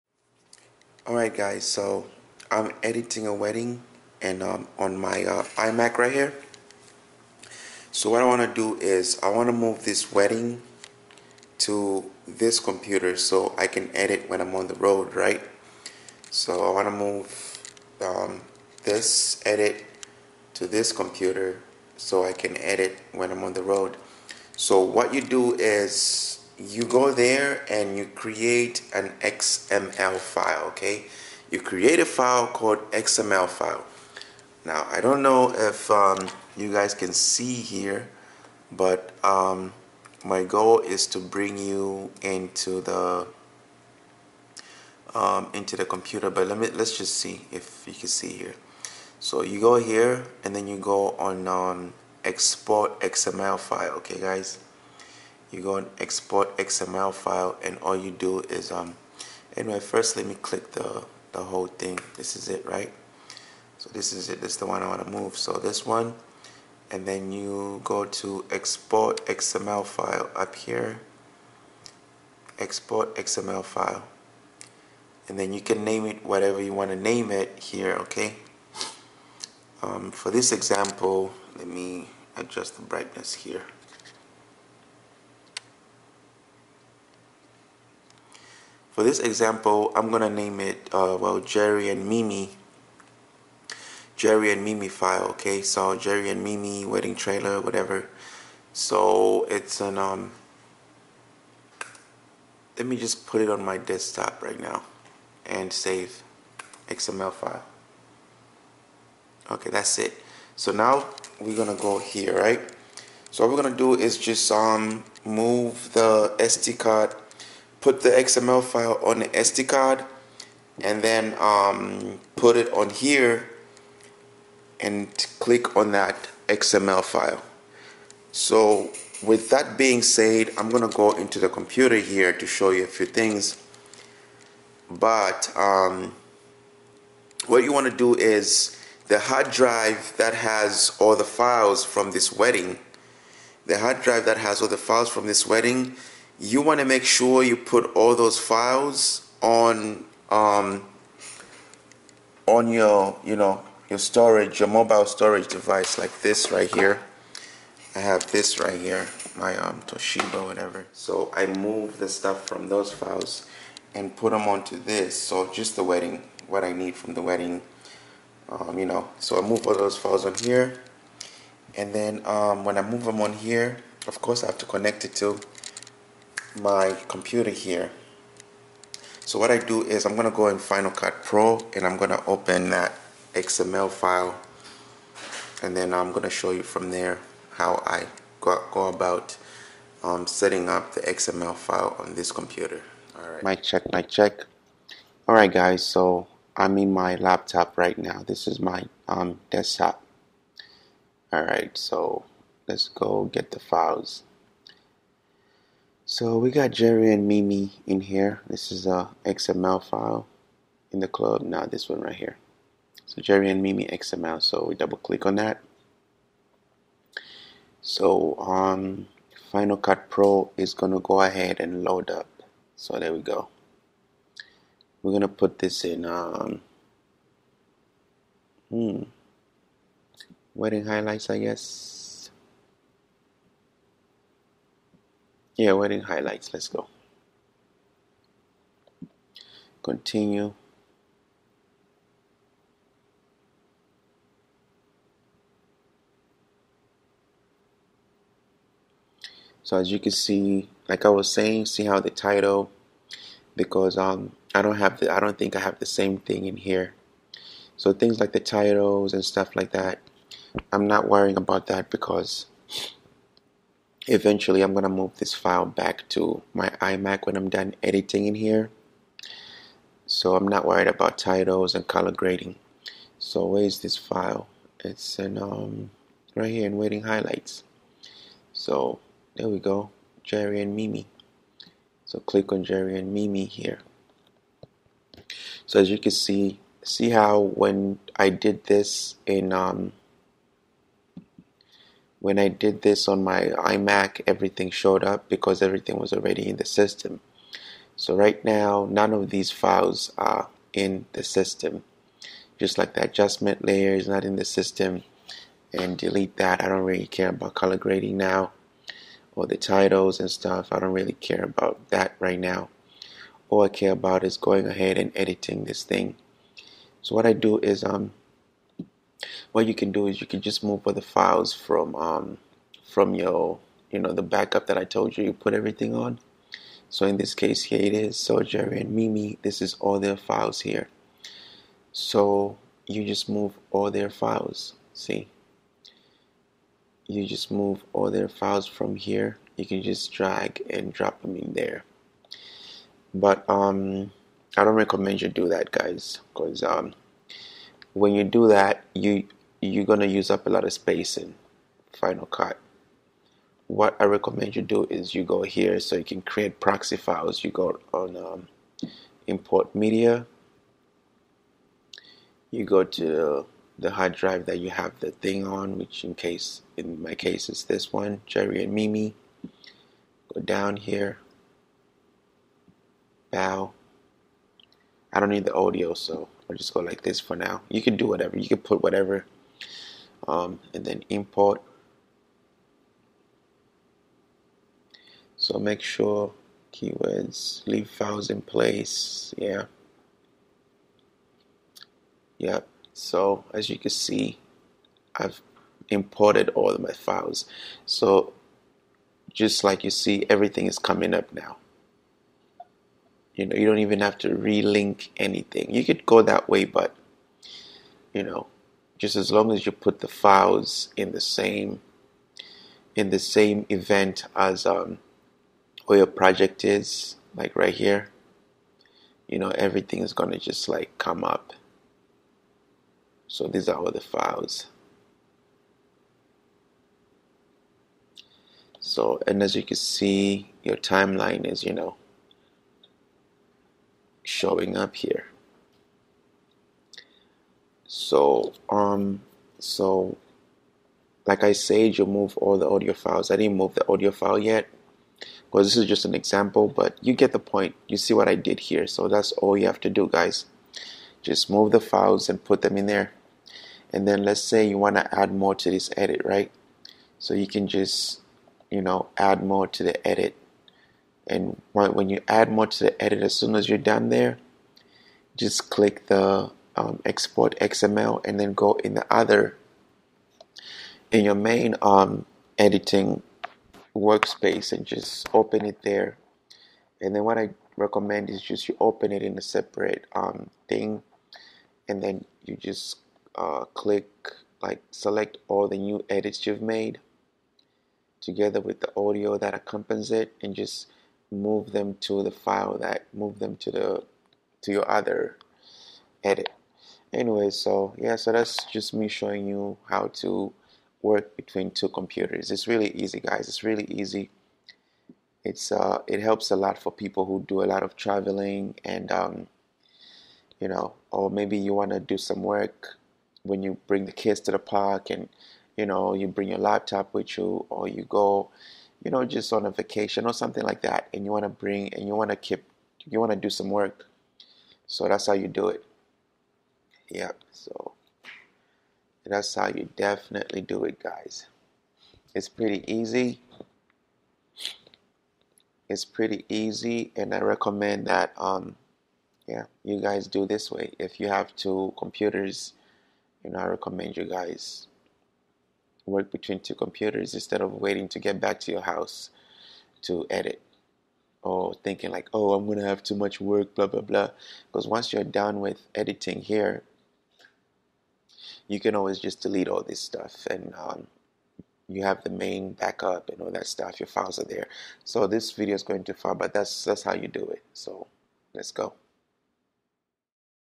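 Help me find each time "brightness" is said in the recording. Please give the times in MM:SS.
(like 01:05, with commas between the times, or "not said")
01:22.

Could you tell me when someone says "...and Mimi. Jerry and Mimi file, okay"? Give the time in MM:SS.
01:31.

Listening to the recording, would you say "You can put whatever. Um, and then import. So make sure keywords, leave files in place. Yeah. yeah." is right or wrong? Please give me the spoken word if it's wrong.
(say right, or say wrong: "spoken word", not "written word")
right.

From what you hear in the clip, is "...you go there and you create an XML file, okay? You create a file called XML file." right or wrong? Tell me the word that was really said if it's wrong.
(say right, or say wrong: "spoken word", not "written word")
right.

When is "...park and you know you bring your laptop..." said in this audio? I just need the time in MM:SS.
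08:34.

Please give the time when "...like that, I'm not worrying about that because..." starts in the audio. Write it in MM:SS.
04:19.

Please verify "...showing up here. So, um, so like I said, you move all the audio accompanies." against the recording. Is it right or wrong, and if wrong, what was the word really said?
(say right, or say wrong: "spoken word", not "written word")
wrong: "files", not "accompanies".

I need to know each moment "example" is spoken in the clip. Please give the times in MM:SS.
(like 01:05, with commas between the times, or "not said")
01:20, 01:29, 07:26.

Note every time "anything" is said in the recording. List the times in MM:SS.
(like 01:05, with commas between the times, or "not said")
06:45.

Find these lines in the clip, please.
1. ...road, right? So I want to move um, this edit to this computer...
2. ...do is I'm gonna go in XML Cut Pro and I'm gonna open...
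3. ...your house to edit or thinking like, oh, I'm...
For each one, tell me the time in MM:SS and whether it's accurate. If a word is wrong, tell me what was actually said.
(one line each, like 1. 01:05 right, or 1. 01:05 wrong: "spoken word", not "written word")
1. 00:14 right
2. 02:59 wrong: "Final", not "XML"
3. 09:08 right.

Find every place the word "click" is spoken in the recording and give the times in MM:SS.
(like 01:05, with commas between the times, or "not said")
01:00, 02:05, 03:34, 04:42, 07:45, 08:03.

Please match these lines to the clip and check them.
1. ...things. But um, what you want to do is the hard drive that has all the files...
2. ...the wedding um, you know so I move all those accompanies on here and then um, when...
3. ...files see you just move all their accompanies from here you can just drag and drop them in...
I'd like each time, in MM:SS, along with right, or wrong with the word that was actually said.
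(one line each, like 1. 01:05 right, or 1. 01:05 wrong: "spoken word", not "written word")
1. 02:13 right
2. 02:47 wrong: "files", not "accompanies"
3. 05:34 wrong: "files", not "accompanies".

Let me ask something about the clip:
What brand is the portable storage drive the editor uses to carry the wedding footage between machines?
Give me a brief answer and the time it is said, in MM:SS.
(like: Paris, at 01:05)
Toshiba, at 02:39.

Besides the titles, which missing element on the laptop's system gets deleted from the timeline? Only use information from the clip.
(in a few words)
adjustment layer.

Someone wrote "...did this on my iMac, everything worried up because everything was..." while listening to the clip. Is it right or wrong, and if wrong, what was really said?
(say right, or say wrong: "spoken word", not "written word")
wrong: "showed", not "worried".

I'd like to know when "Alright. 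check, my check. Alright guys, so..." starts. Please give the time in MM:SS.
03:13.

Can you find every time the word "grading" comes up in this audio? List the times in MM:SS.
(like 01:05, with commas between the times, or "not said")
04:32, 05:07.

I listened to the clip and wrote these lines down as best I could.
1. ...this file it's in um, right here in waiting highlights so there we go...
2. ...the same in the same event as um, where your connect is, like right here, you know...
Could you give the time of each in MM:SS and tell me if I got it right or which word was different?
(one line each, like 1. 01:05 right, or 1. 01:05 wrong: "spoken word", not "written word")
1. 04:33 right
2. 06:51 wrong: "project", not "connect".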